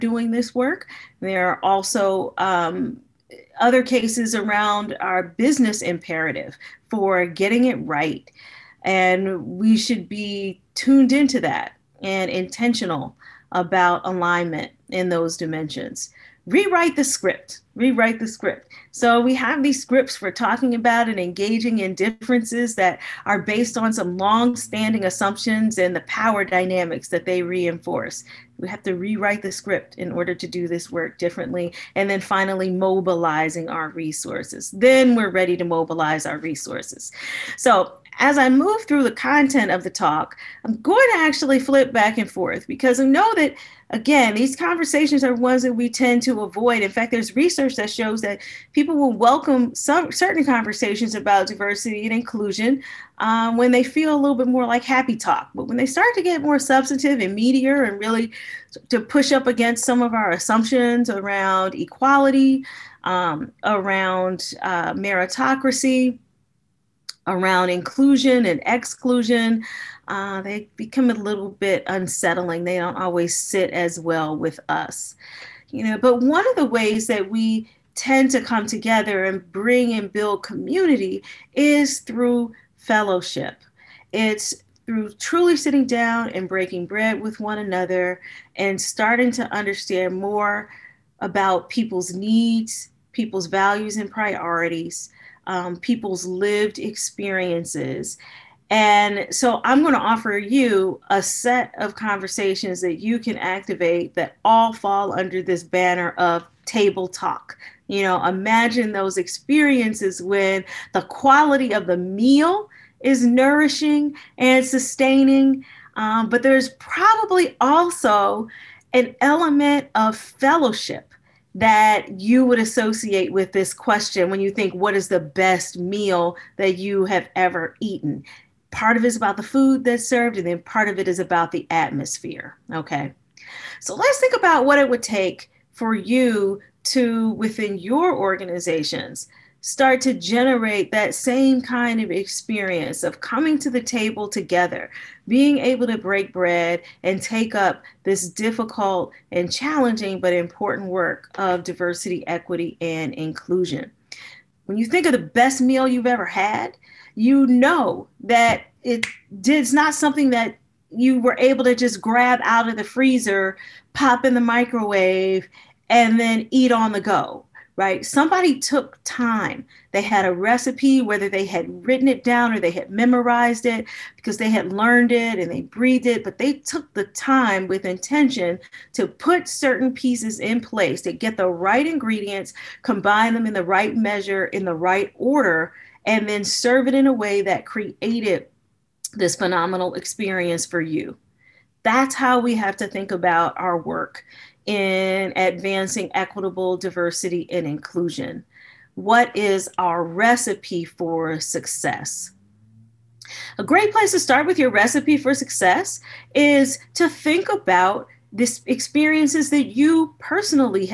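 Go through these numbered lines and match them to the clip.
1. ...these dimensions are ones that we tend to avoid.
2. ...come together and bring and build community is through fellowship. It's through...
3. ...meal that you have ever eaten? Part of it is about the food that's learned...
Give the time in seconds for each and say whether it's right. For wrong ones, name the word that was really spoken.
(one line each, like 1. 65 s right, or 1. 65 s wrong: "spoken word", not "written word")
1. 44 s wrong: "conversations", not "dimensions"
2. 78 s right
3. 125 s wrong: "served", not "learned".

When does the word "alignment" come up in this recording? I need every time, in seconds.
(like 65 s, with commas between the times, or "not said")
14 s.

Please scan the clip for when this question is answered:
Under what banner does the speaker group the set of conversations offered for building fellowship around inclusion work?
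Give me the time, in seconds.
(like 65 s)
106 s.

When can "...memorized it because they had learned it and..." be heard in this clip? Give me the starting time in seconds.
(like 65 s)
172 s.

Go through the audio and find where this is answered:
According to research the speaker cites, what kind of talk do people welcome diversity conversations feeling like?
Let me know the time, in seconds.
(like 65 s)
54 s.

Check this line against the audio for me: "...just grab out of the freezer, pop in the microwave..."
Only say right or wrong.
right.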